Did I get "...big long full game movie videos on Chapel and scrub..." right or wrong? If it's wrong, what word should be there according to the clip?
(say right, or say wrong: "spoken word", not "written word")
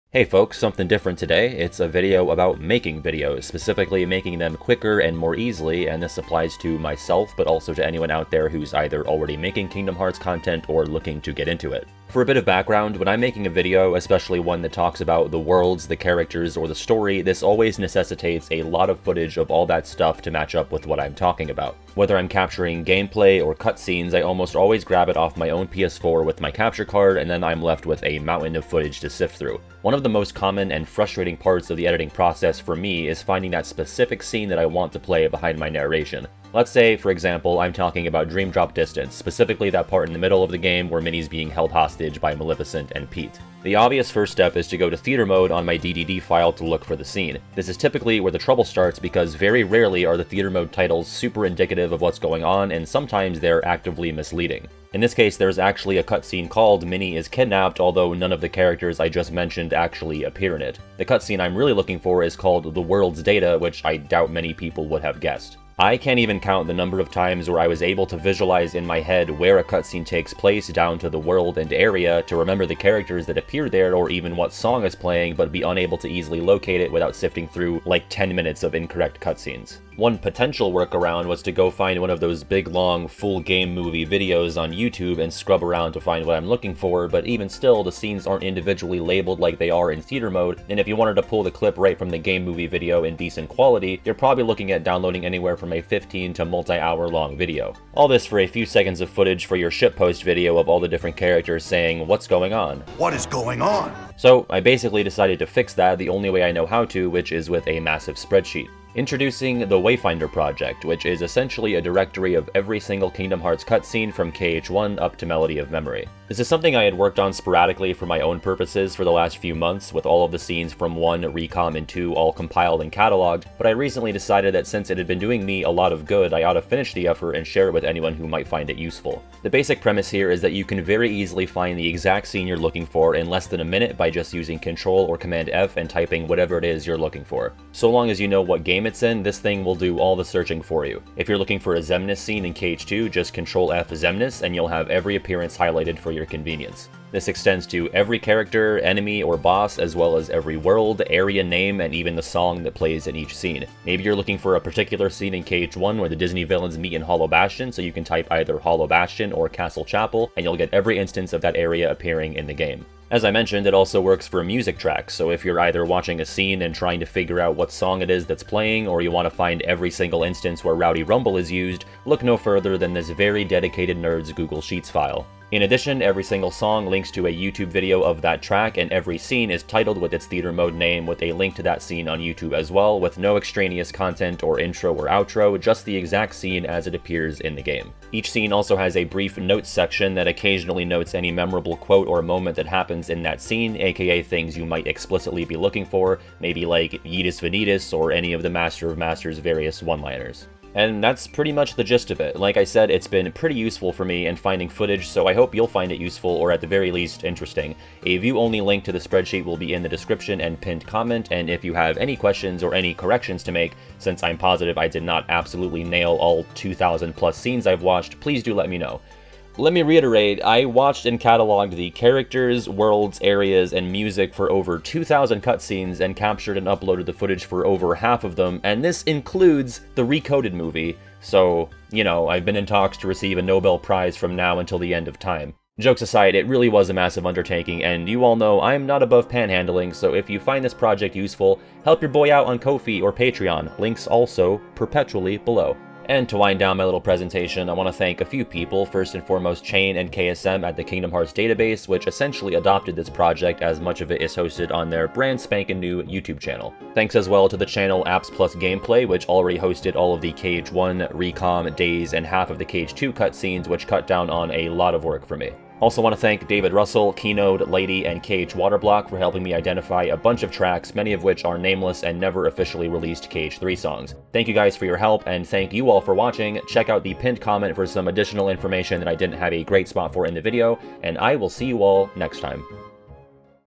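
wrong: "YouTube", not "Chapel".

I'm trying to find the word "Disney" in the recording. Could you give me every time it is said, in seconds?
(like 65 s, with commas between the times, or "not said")
156 s.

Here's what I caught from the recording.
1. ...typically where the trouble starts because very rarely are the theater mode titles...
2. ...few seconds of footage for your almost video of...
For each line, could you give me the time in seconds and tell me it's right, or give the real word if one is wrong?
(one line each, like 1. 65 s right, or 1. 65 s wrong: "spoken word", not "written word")
1. 47 s right
2. 98 s wrong: "shitpost", not "almost".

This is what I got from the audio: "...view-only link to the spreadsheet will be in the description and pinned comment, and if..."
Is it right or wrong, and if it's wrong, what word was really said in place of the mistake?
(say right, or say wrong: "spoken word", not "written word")
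right.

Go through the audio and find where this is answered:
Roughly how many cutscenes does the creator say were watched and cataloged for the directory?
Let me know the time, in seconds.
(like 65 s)
224 s.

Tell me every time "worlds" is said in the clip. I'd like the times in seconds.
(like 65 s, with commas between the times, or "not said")
15 s, 62 s, 71 s, 150 s, 222 s.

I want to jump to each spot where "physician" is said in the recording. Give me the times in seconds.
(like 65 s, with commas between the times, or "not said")
not said.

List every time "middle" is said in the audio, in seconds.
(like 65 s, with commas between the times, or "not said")
40 s.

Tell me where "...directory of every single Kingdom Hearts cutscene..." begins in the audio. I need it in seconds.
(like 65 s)
111 s.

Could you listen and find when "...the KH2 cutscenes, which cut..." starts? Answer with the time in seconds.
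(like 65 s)
262 s.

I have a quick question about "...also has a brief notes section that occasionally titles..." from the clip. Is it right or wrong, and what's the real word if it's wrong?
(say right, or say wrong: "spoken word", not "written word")
wrong: "notes", not "titles".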